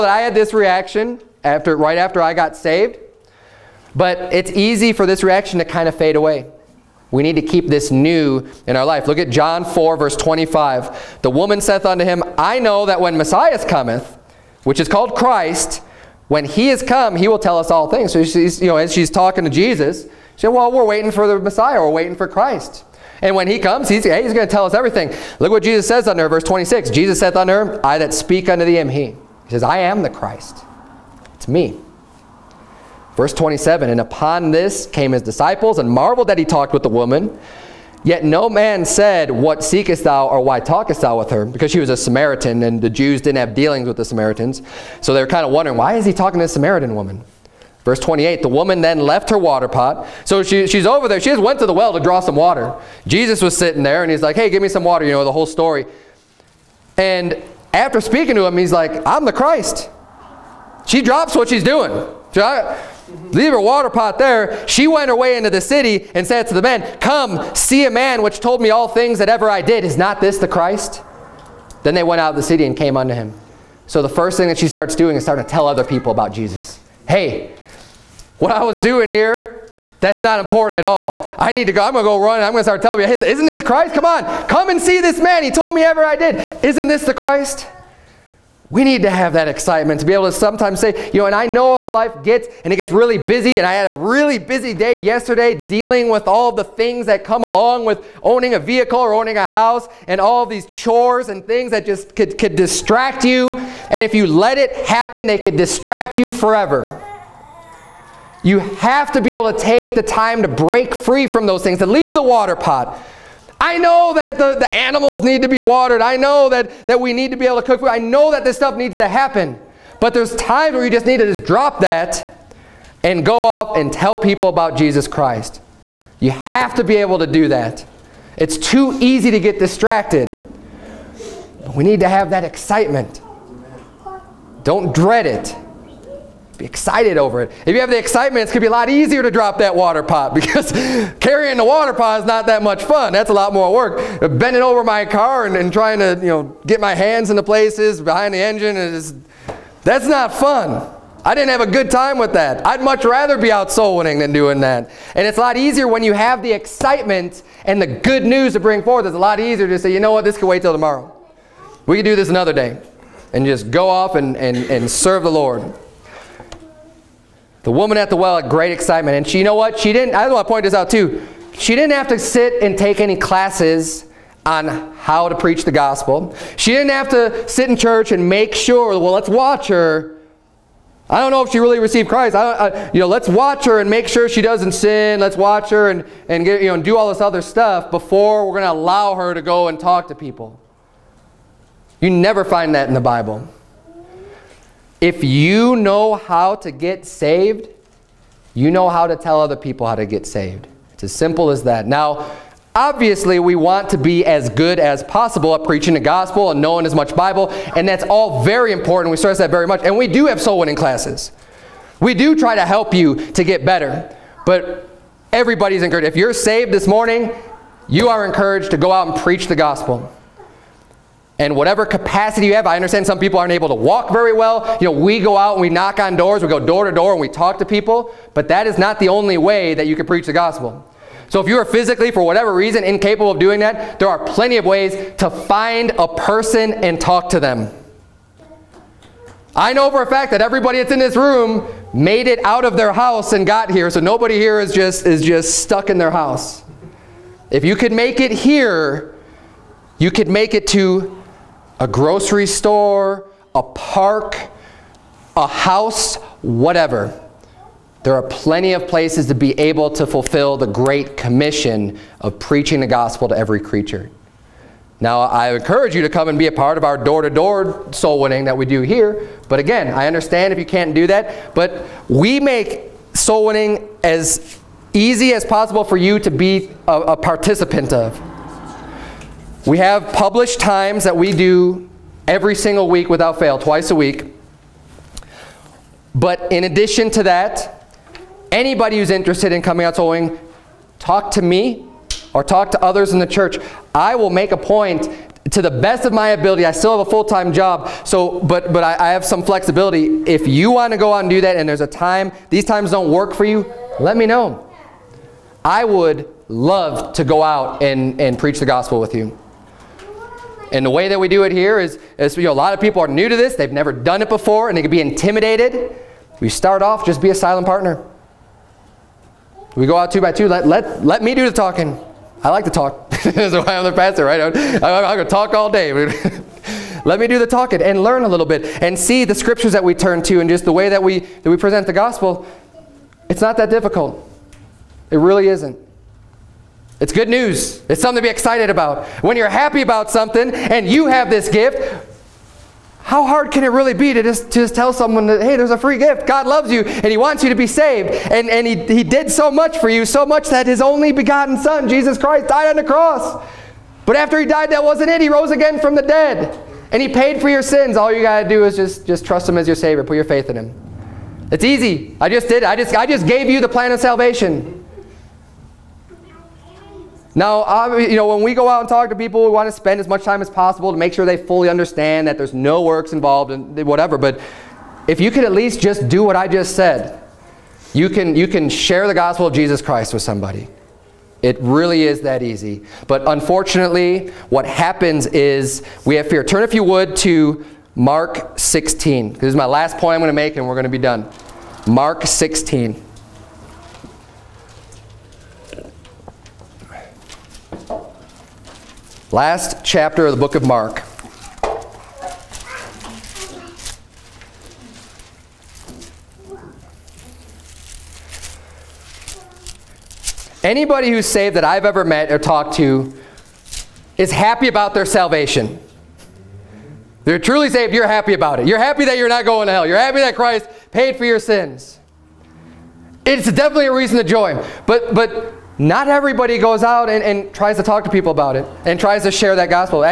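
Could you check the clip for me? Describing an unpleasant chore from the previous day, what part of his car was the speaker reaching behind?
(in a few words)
The engine.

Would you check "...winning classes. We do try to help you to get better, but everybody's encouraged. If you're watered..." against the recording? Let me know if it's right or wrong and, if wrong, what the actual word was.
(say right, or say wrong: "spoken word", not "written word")
wrong: "saved", not "watered".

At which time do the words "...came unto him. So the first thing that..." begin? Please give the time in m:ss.
1:12.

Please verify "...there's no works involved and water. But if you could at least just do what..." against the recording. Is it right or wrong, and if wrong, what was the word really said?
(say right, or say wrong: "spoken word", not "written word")
wrong: "whatever", not "water".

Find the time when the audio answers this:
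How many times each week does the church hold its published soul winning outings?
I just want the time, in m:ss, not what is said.
4:43.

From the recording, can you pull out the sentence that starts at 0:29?
He says, I am the Christ.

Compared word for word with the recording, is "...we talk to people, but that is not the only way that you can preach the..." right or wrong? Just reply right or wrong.
right.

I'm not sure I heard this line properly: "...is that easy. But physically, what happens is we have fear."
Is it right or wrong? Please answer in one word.
wrong.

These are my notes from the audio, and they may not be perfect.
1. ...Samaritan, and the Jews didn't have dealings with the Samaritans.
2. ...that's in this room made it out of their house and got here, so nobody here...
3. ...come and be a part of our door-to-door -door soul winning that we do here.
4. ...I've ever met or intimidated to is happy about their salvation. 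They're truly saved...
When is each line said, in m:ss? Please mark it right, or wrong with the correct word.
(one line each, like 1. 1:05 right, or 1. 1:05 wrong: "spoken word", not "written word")
1. 0:41 right
2. 4:00 right
3. 4:26 right
4. 6:51 wrong: "talked", not "intimidated".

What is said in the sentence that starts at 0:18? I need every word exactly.
So she's, you know, as she's talking to Jesus, she said, well, we're waiting for the Messiah.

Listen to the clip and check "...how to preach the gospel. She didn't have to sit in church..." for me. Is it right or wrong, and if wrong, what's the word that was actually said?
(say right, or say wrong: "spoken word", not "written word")
right.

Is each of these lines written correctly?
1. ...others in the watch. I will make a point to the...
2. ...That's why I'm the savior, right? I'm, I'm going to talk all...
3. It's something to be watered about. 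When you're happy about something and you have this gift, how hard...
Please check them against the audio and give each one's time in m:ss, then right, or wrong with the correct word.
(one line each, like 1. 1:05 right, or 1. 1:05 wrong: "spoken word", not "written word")
1. 4:52 wrong: "church", not "watch"
2. 5:23 wrong: "pastor", not "savior"
3. 5:37 wrong: "excited", not "watered".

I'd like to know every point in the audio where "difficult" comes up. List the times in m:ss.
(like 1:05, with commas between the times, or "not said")
5:33.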